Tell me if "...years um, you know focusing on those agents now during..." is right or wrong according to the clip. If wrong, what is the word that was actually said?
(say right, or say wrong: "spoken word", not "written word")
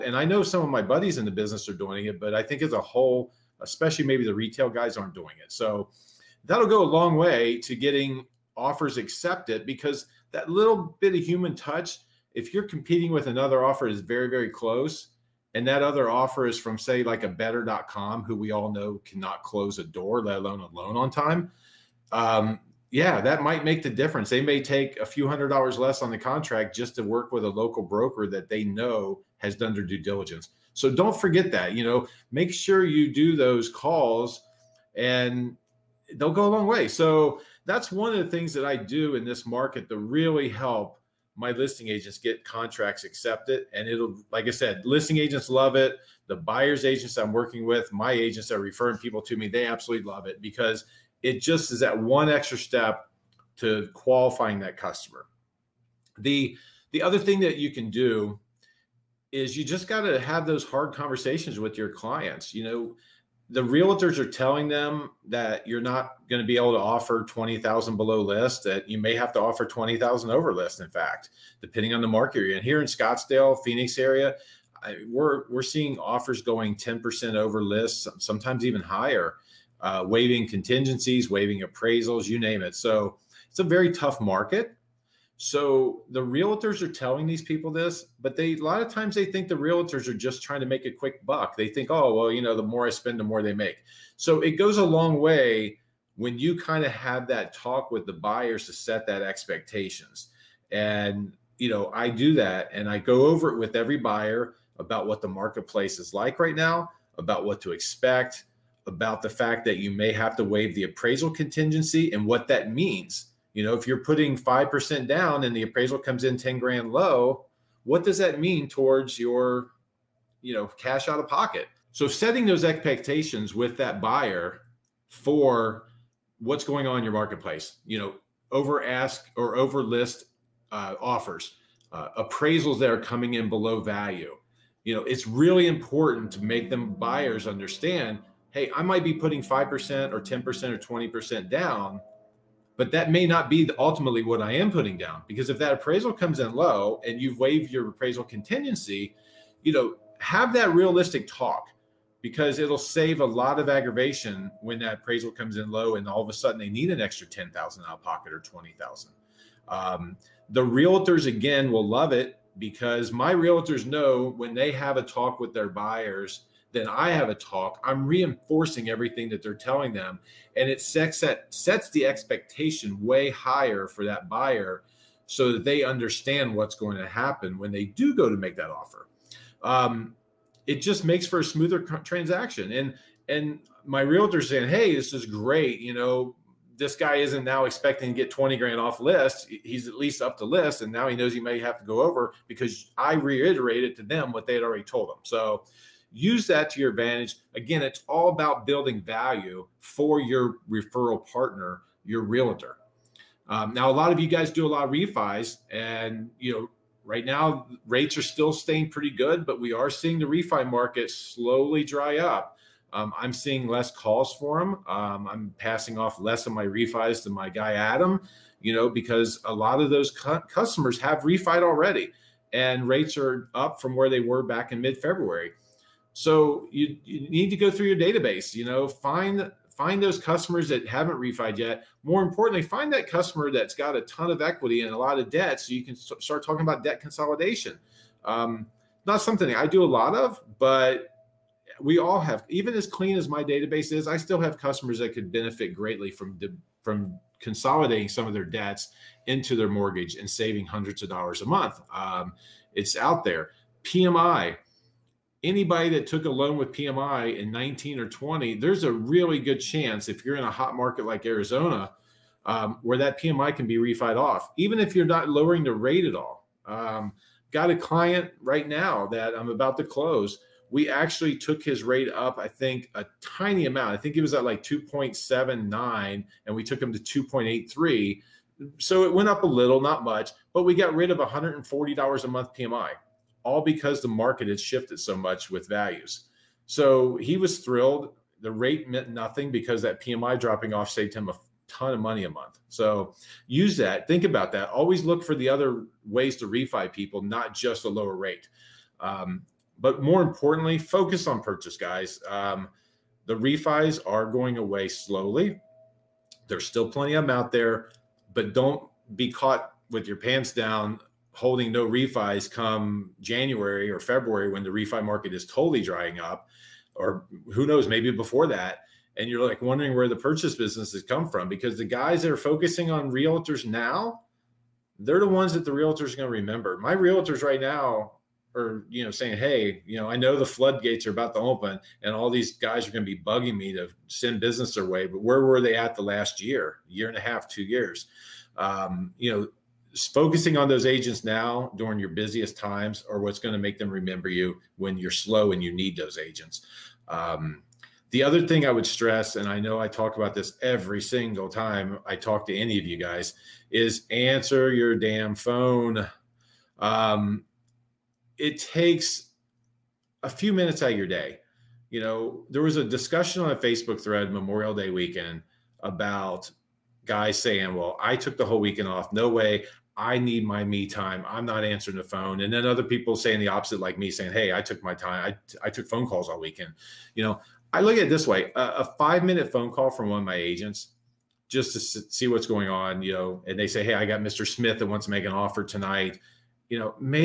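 right.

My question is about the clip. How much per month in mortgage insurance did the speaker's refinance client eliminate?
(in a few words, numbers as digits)
$140.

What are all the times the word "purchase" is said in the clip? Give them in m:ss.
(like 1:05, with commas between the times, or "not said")
5:01, 5:20.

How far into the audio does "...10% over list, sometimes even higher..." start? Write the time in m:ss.
1:16.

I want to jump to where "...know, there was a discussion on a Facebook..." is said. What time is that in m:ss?
6:01.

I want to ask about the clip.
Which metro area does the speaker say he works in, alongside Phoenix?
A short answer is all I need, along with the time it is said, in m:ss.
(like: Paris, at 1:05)
Scottsdale, at 1:12.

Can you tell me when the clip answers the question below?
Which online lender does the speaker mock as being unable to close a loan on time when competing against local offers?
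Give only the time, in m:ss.
0:17.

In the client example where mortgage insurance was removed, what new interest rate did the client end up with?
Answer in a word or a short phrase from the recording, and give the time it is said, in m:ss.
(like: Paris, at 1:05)
2.83, at 4:36.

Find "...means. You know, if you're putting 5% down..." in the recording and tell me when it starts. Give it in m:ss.
1:52.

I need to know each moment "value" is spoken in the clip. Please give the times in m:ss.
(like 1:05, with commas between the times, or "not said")
2:13, 3:19, 4:45.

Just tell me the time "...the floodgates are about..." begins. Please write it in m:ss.
5:30.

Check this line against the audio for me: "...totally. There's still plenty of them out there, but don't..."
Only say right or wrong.
wrong.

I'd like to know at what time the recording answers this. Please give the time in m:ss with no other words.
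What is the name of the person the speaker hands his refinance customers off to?
3:37.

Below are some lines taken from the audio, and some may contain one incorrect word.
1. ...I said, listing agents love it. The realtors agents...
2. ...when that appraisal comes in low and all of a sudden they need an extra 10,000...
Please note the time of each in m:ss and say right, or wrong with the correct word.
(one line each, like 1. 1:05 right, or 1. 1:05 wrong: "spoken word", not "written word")
1. 0:44 wrong: "buyers", not "realtors"
2. 2:34 right.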